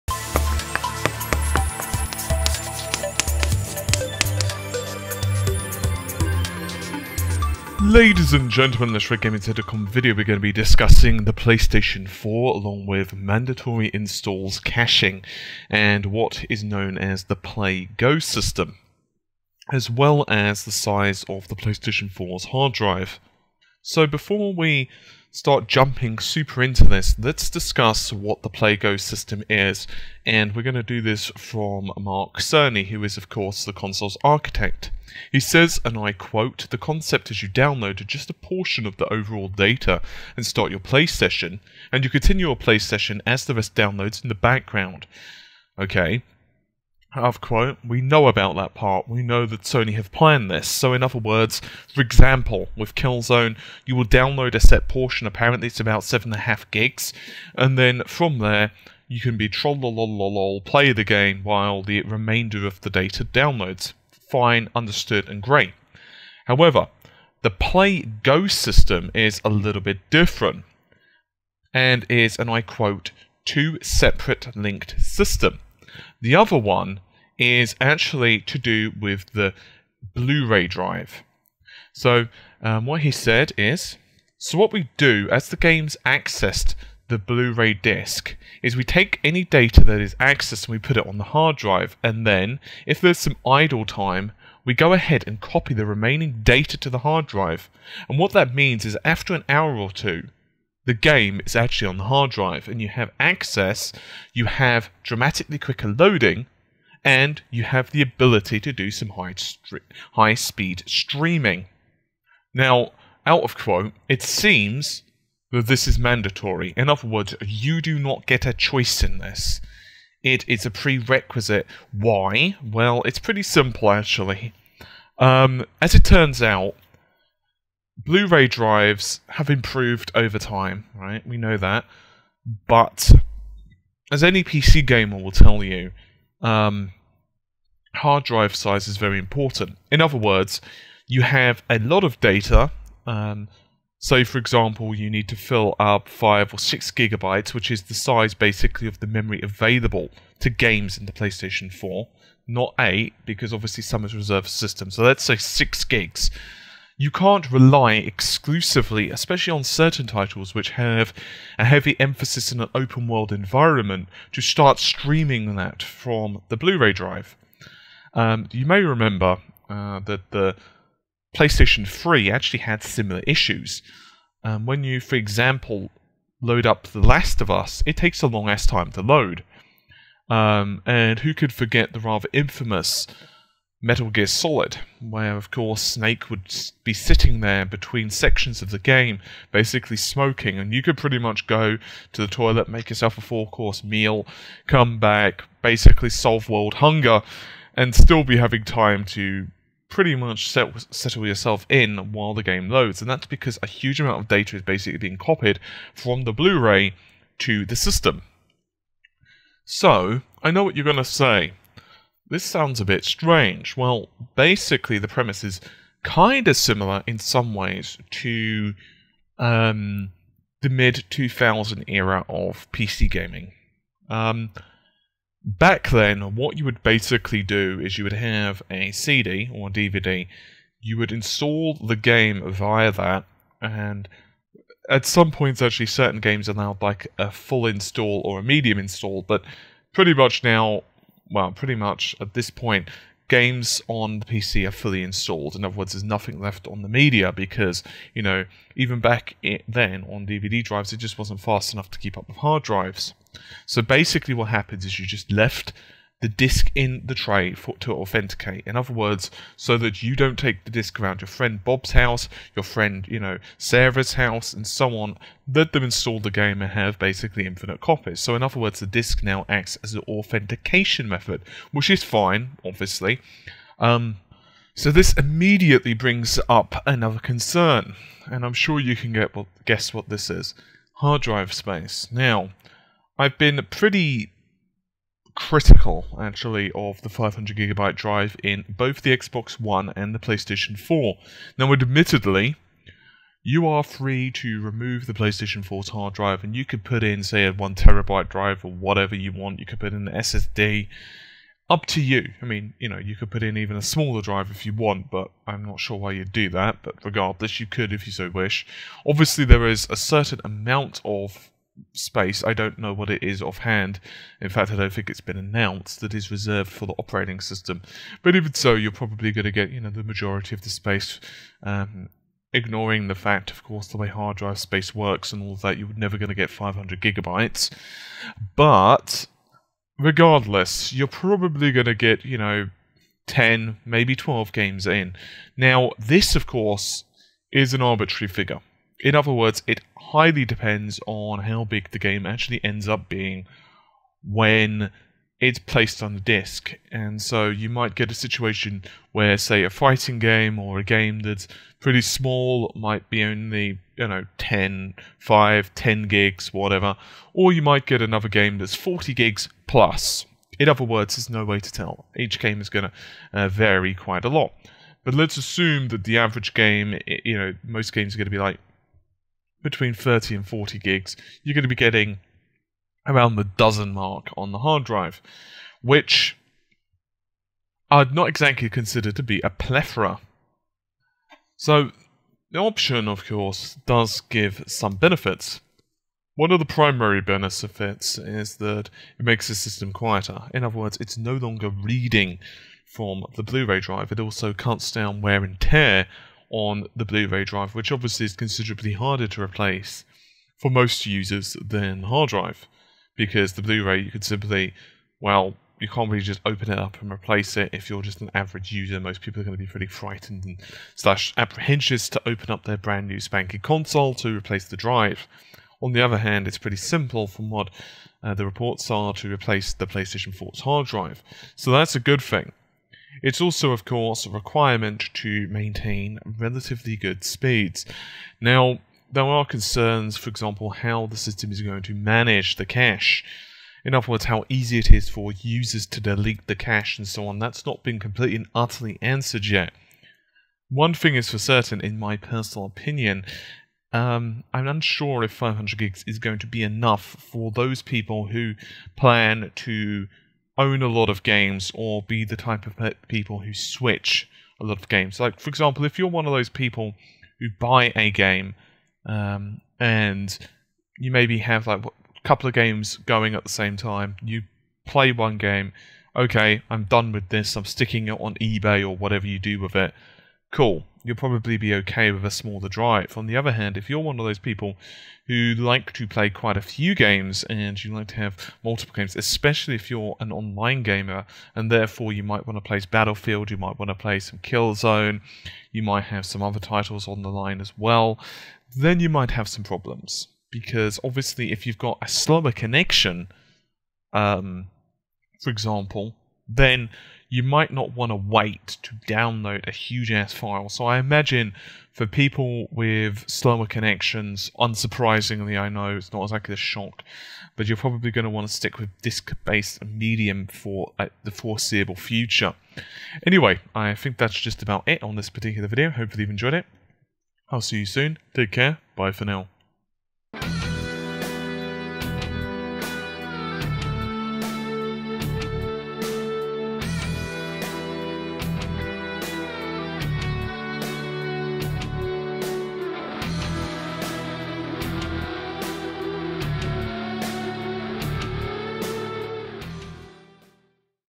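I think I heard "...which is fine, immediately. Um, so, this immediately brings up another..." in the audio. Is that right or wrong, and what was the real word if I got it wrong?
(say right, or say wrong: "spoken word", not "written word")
wrong: "obviously", not "immediately".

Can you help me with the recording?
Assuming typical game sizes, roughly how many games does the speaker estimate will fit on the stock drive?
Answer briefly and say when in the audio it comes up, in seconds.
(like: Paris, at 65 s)
10 to 12, at 333 s.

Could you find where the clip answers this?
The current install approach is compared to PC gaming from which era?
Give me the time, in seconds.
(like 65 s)
220 s.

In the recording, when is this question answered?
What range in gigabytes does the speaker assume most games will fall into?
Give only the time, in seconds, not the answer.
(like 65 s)
369 s.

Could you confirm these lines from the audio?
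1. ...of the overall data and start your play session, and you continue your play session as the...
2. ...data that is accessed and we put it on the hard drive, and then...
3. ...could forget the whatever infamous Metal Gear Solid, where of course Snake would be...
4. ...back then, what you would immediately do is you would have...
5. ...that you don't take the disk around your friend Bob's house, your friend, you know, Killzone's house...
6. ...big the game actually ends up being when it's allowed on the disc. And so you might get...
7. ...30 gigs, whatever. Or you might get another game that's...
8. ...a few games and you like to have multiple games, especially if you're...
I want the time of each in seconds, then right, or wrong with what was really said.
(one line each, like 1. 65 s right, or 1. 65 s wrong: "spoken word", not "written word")
1. 38 s right
2. 89 s right
3. 181 s wrong: "rather", not "whatever"
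4. 225 s wrong: "basically", not "immediately"
5. 259 s wrong: "Sarah", not "Killzone"
6. 341 s wrong: "placed", not "allowed"
7. 355 s wrong: "10", not "30"
8. 476 s right.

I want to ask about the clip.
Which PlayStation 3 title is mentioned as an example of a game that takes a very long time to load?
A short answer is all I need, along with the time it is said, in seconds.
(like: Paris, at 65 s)
The Last of Us, at 176 s.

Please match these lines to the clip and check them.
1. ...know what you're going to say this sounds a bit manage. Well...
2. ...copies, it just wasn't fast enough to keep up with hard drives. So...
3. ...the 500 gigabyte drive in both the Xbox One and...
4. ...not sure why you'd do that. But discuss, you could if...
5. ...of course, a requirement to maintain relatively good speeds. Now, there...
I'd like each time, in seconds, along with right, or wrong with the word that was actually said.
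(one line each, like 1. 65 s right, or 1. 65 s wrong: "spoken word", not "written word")
1. 210 s wrong: "strange", not "manage"
2. 250 s wrong: "drives", not "copies"
3. 287 s right
4. 305 s wrong: "regardless", not "discuss"
5. 423 s right.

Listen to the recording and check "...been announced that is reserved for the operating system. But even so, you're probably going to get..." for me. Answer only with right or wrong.
right.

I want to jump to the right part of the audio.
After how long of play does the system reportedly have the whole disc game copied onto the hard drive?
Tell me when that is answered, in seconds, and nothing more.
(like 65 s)
99 s.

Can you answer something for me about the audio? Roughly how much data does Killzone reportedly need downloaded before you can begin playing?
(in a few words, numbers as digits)
7.5 gigs.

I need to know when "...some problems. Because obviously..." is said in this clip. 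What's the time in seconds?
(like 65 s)
489 s.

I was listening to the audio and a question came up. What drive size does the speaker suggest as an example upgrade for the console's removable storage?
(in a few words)
1 terabyte.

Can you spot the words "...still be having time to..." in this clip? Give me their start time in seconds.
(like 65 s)
197 s.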